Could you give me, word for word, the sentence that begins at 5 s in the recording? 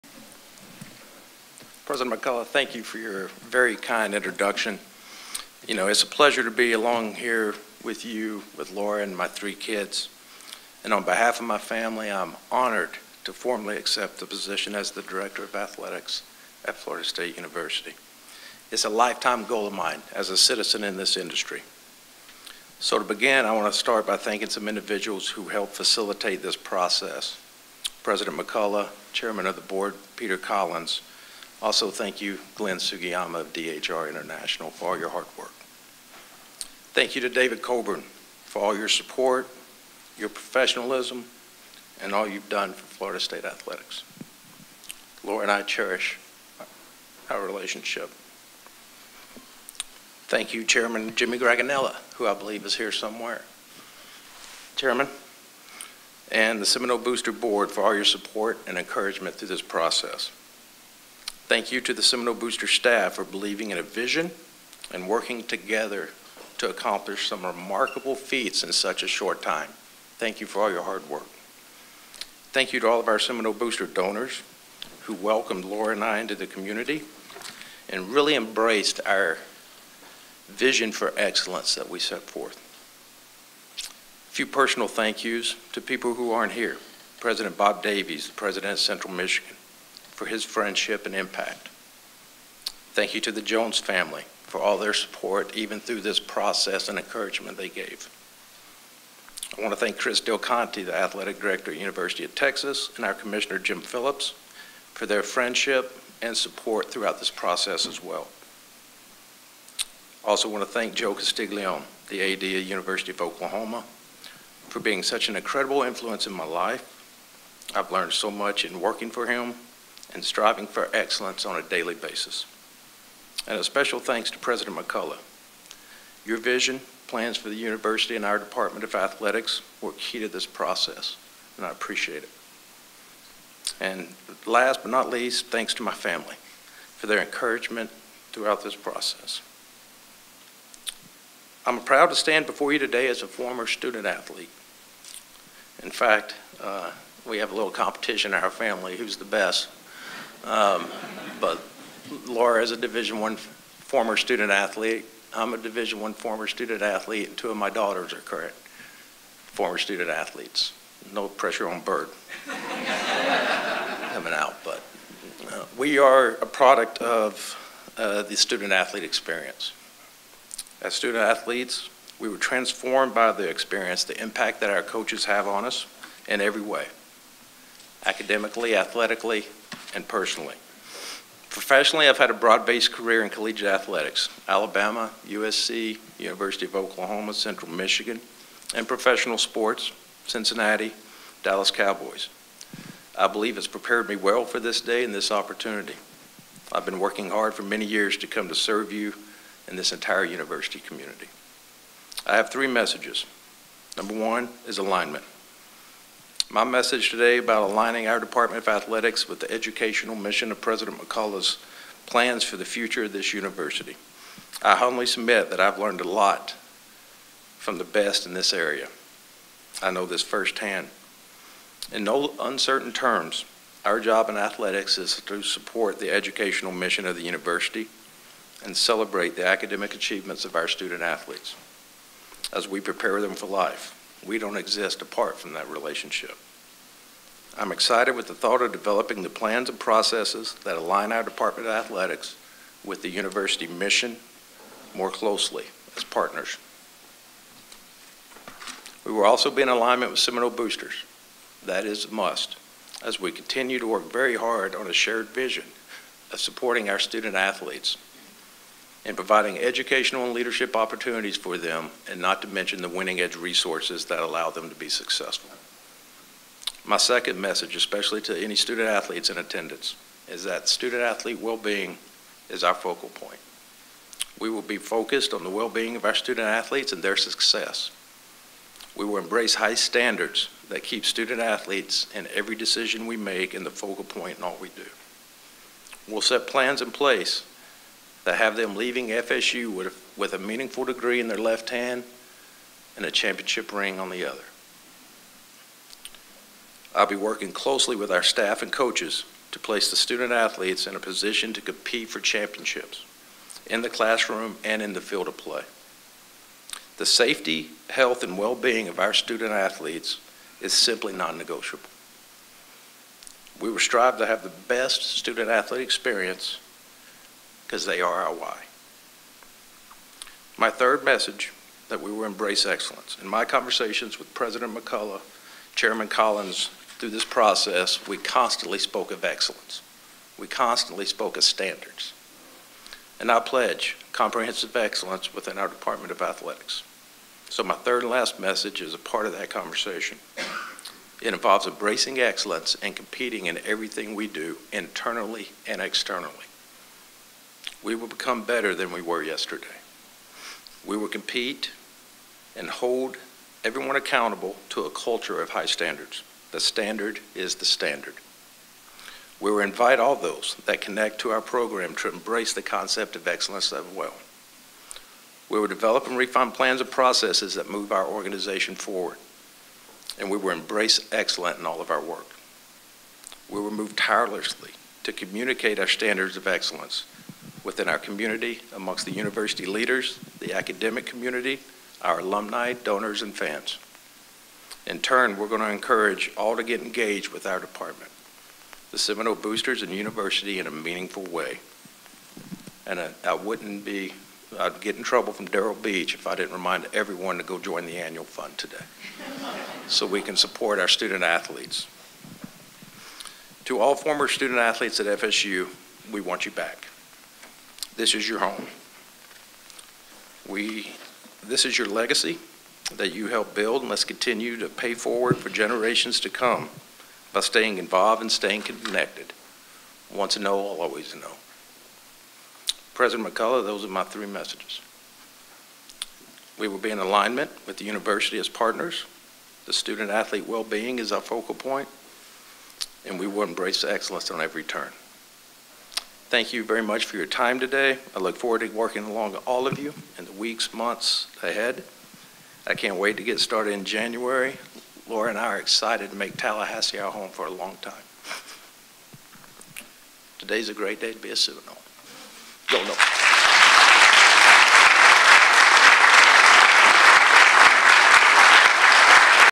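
You know, it's a pleasure to be along here with you, with Laura, and my three kids.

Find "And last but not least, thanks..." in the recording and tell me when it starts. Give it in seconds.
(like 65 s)
133 s.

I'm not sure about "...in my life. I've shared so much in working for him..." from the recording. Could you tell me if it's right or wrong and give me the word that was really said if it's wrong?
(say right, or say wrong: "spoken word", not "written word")
wrong: "learned", not "shared".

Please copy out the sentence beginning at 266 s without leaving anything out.
My second message, especially to any student athletes in attendance, is that student athlete well being is our focal point.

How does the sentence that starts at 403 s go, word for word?
To all former student athletes at FSU, we want you back.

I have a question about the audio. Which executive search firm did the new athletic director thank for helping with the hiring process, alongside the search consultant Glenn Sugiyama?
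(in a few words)
DHR International.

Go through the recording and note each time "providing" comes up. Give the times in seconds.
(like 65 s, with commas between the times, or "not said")
259 s.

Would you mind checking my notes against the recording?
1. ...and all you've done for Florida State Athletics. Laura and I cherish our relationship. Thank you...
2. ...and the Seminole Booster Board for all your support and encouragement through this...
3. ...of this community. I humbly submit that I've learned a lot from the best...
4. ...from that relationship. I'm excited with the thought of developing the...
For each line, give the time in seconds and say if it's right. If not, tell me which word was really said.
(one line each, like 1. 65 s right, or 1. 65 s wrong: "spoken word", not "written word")
1. 42 s right
2. 56 s right
3. 213 s wrong: "university", not "community"
4. 235 s right.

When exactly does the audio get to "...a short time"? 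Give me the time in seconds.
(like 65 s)
69 s.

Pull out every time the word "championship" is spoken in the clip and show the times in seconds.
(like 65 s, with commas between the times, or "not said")
293 s, 302 s.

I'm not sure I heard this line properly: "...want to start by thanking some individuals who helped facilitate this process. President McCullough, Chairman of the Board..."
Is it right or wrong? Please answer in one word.
right.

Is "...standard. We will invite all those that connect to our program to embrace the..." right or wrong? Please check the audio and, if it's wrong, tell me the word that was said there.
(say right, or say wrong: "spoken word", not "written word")
right.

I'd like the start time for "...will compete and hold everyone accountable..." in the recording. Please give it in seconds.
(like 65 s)
350 s.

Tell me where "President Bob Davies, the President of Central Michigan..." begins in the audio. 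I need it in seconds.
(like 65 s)
87 s.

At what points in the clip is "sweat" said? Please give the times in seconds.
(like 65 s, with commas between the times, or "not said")
not said.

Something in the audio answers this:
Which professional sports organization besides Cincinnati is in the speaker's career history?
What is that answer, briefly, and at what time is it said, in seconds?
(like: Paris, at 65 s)
Dallas Cowboys, at 191 s.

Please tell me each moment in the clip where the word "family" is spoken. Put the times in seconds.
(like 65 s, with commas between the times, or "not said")
11 s, 93 s, 135 s, 148 s.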